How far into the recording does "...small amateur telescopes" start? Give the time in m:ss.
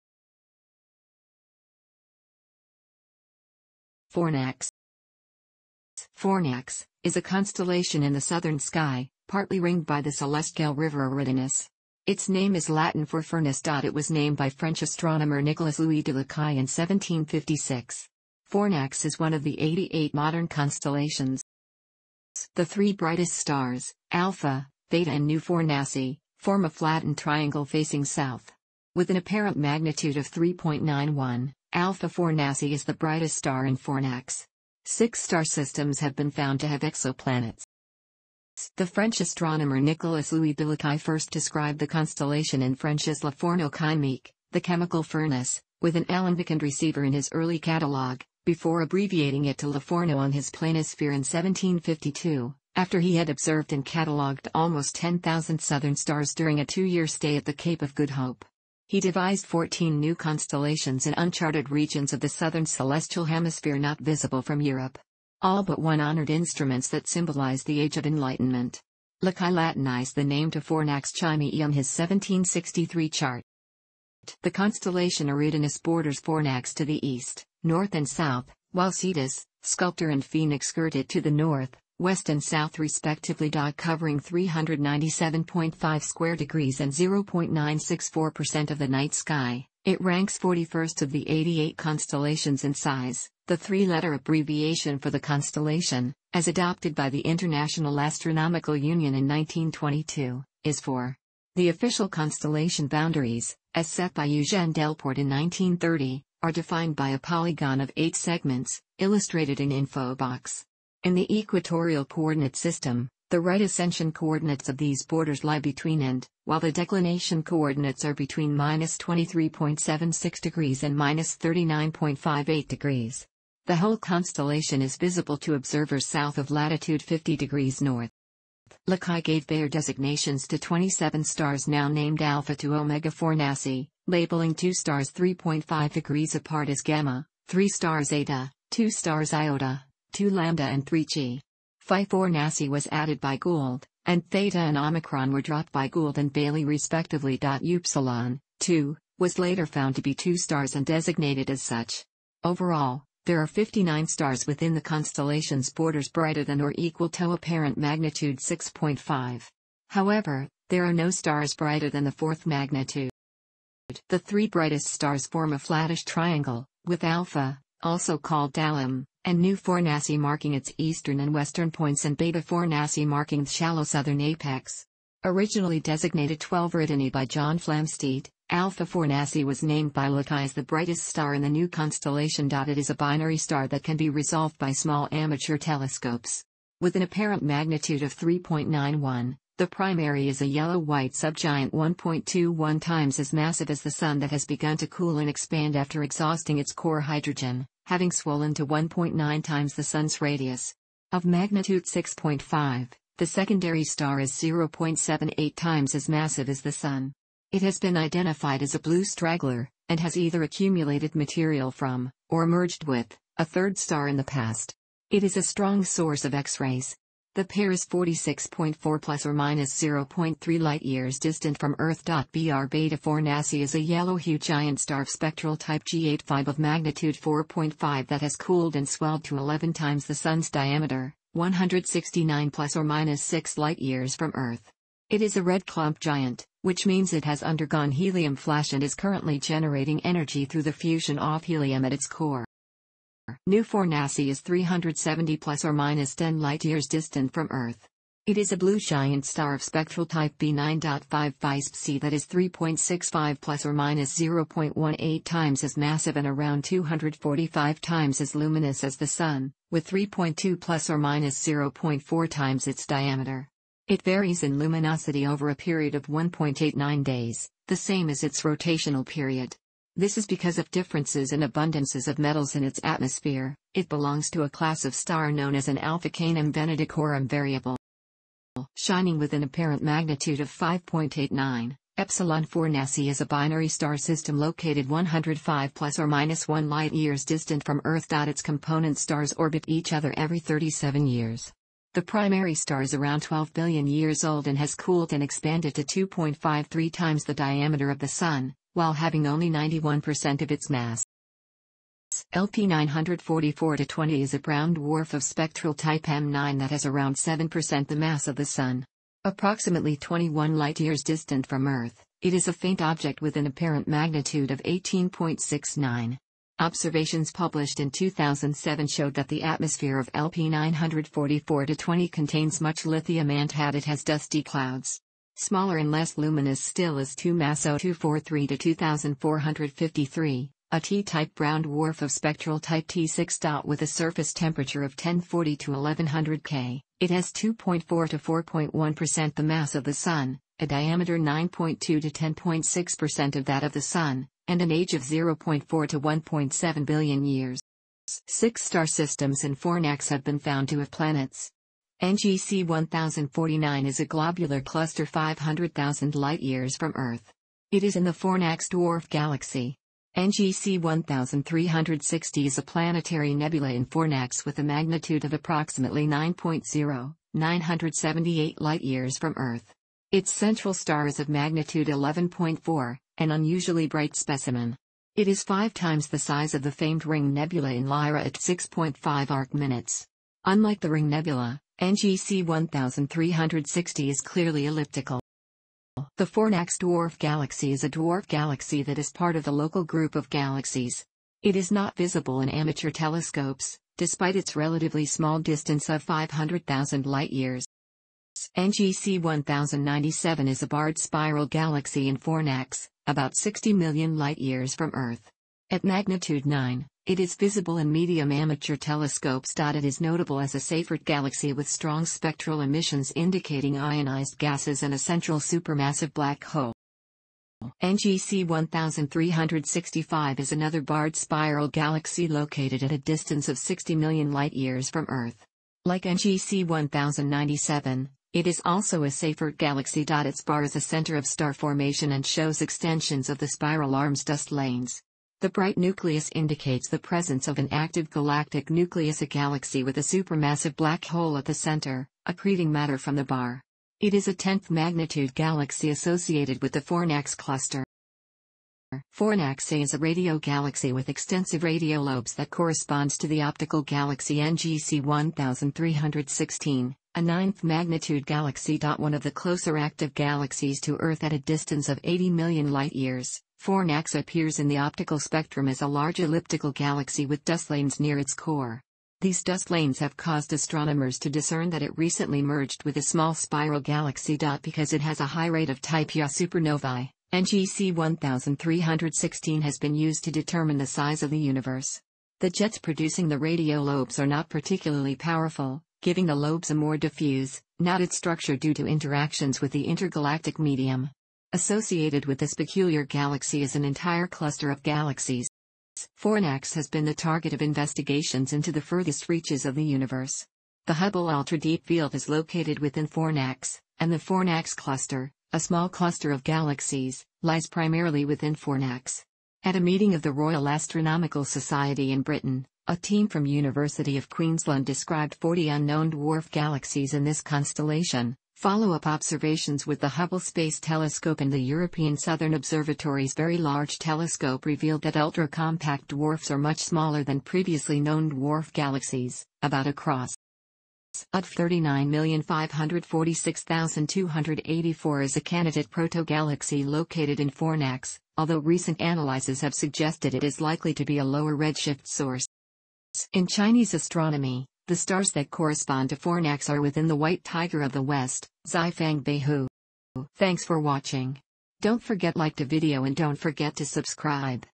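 3:04.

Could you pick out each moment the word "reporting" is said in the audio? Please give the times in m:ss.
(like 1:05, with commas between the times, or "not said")
not said.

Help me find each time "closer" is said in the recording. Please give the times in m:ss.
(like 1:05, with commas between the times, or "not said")
7:39.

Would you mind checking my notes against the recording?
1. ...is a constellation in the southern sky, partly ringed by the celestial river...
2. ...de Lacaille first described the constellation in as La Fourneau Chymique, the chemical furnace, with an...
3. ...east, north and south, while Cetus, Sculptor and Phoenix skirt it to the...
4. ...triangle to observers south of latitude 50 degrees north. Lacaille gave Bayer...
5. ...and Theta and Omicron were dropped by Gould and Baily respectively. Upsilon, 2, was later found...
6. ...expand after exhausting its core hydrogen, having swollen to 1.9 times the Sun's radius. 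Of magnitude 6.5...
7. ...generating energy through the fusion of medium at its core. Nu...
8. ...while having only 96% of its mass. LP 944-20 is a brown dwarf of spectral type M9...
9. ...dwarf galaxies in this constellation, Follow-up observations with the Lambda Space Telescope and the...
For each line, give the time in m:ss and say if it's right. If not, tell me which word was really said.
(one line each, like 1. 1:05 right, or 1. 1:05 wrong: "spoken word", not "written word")
1. 0:07 right
2. 0:40 right
3. 1:17 right
4. 2:04 wrong: "visible", not "triangle"
5. 2:24 right
6. 3:15 right
7. 3:59 wrong: "helium", not "medium"
8. 4:58 wrong: "91", not "96"
9. 8:36 wrong: "Hubble", not "Lambda".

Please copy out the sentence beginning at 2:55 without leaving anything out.
Originally designated 12 Eridani by John Flamsteed, Alpha Fornacis was named by Lacaille as the brightest star in the new constellation.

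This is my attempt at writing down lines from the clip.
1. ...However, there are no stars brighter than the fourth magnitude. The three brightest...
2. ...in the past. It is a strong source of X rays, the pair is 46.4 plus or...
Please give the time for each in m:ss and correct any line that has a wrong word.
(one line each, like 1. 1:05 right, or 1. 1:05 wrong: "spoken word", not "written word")
1. 2:39 right
2. 3:34 right.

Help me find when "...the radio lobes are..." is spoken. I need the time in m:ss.
8:03.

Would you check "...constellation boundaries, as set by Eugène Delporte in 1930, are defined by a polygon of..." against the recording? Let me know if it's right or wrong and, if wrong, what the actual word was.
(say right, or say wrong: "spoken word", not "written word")
right.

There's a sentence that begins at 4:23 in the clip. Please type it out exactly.
It varies in luminosity over a period of 1.89 days, the same as its rotational period.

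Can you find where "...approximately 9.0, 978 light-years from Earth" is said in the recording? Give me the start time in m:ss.
6:05.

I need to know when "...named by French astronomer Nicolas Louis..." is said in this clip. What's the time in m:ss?
0:14.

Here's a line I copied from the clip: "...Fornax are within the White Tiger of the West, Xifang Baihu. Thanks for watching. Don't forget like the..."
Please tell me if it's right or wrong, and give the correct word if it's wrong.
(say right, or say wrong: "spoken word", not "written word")
right.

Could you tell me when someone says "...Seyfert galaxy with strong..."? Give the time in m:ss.
6:50.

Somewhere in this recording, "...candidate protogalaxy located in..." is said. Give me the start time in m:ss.
8:55.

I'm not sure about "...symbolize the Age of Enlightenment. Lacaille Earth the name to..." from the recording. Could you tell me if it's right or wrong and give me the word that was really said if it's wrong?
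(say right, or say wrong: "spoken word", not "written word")
wrong: "Latinized", not "Earth".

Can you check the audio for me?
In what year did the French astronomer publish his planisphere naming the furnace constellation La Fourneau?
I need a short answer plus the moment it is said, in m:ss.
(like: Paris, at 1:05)
1752, at 0:51.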